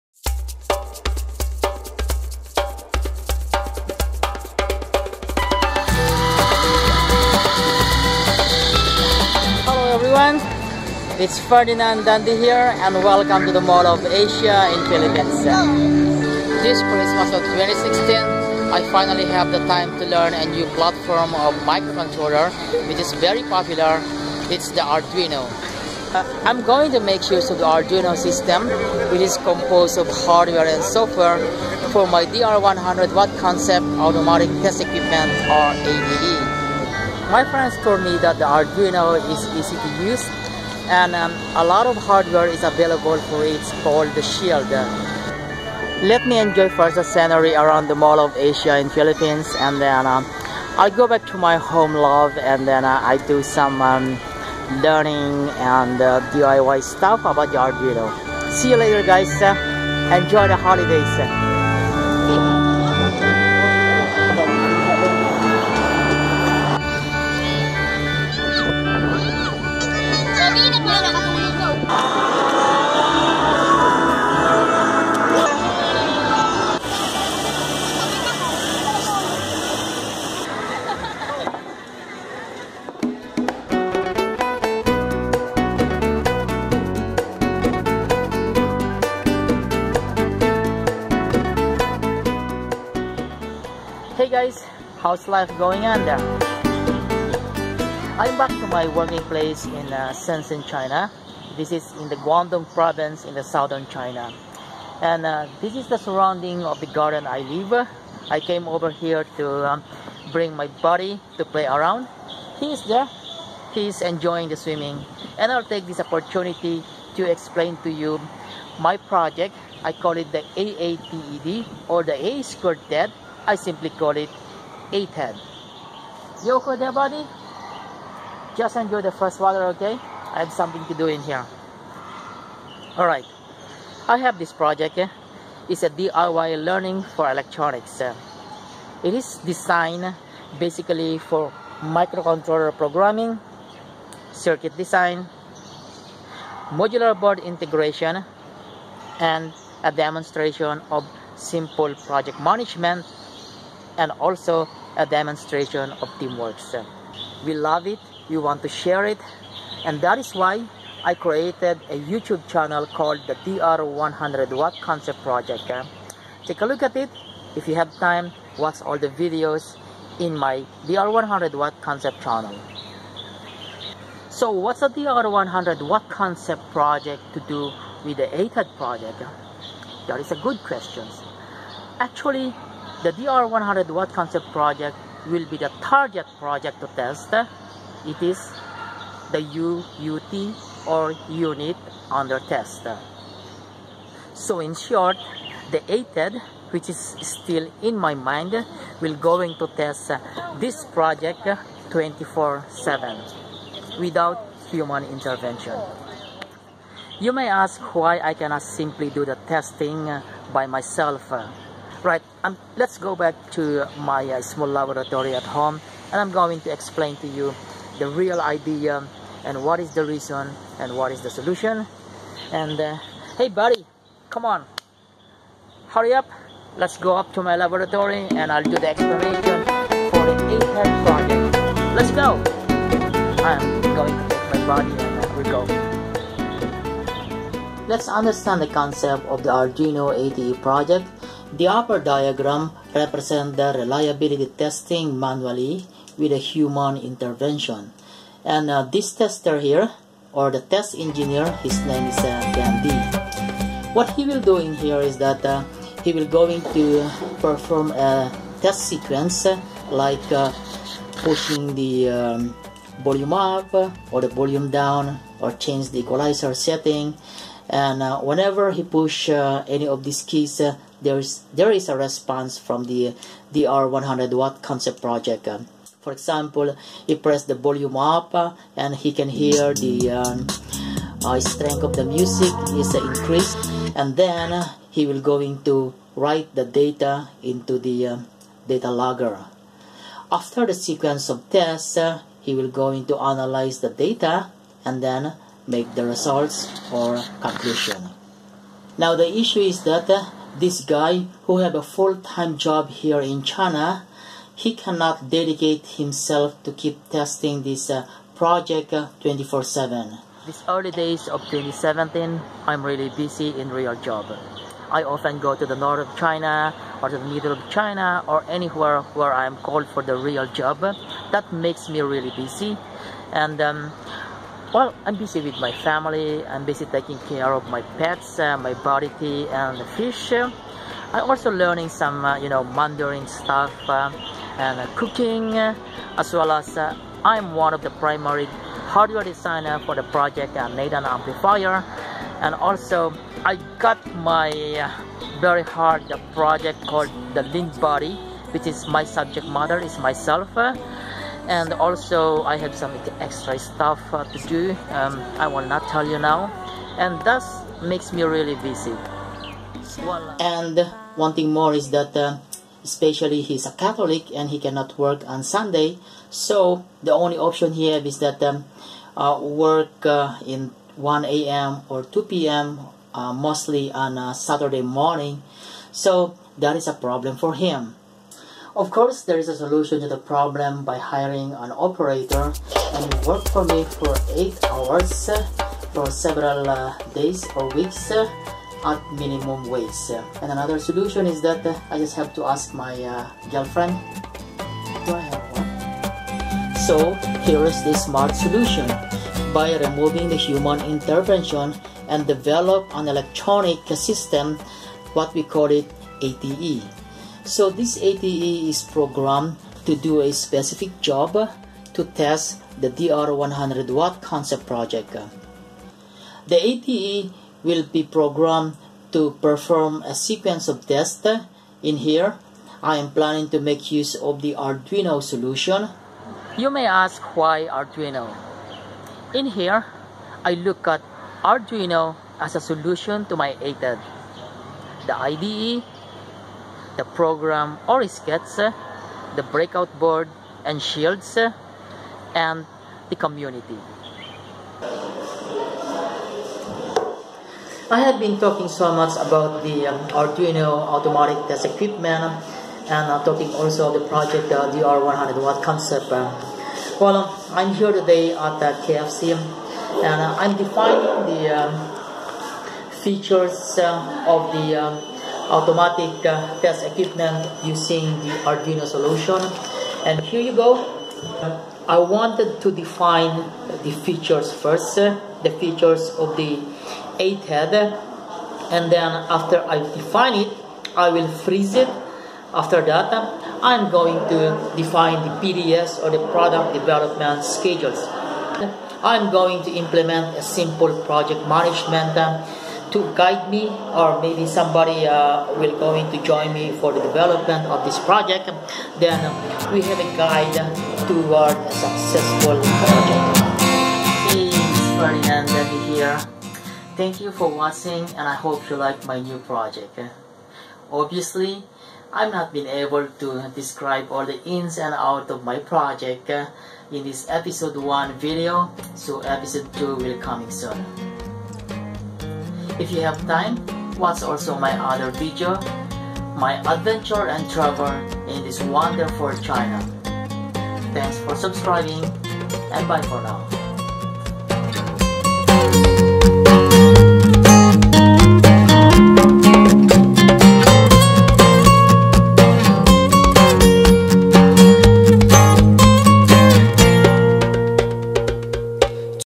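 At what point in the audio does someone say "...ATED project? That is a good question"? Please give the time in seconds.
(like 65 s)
178 s.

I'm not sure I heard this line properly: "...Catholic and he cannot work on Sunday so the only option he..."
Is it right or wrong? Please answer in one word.
right.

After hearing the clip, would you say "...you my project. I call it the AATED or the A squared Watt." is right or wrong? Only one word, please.
wrong.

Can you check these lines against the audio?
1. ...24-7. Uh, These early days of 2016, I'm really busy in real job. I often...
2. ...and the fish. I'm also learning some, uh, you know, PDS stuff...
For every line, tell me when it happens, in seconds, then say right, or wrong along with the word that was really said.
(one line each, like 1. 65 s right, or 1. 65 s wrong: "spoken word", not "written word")
1. 308 s wrong: "2017", not "2016"
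2. 329 s wrong: "Mandarin", not "PDS".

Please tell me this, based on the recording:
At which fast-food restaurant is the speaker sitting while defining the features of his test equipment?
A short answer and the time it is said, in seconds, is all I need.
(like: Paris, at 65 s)
KFC, at 458 s.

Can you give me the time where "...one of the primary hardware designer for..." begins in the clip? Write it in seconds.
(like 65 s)
337 s.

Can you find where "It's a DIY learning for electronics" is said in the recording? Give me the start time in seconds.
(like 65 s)
135 s.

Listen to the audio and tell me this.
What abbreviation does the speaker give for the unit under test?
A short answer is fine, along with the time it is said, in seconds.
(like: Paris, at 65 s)
UUT, at 189 s.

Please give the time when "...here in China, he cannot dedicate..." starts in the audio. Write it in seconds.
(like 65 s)
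302 s.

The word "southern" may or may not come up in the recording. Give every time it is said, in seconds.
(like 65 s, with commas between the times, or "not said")
103 s.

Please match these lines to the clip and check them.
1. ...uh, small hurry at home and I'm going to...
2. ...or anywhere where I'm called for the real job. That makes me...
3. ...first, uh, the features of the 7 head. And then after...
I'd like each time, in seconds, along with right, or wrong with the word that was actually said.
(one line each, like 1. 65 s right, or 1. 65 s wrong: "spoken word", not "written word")
1. 214 s wrong: "laboratory", not "hurry"
2. 318 s right
3. 474 s wrong: "8", not "7".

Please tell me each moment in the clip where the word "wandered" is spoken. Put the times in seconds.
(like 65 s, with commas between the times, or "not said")
not said.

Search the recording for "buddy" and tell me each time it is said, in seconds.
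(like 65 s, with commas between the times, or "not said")
110 s, 126 s, 223 s.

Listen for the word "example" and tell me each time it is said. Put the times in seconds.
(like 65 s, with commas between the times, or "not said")
276 s.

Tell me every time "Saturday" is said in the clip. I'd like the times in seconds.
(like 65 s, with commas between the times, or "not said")
374 s.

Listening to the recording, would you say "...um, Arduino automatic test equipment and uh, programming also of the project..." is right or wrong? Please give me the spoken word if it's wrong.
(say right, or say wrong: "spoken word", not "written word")
wrong: "talking", not "programming".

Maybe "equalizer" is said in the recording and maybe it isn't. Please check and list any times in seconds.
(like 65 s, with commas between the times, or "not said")
265 s.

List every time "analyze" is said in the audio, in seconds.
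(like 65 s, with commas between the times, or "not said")
293 s.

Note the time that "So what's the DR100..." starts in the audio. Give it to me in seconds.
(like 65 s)
174 s.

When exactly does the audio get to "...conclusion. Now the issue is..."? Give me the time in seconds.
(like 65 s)
297 s.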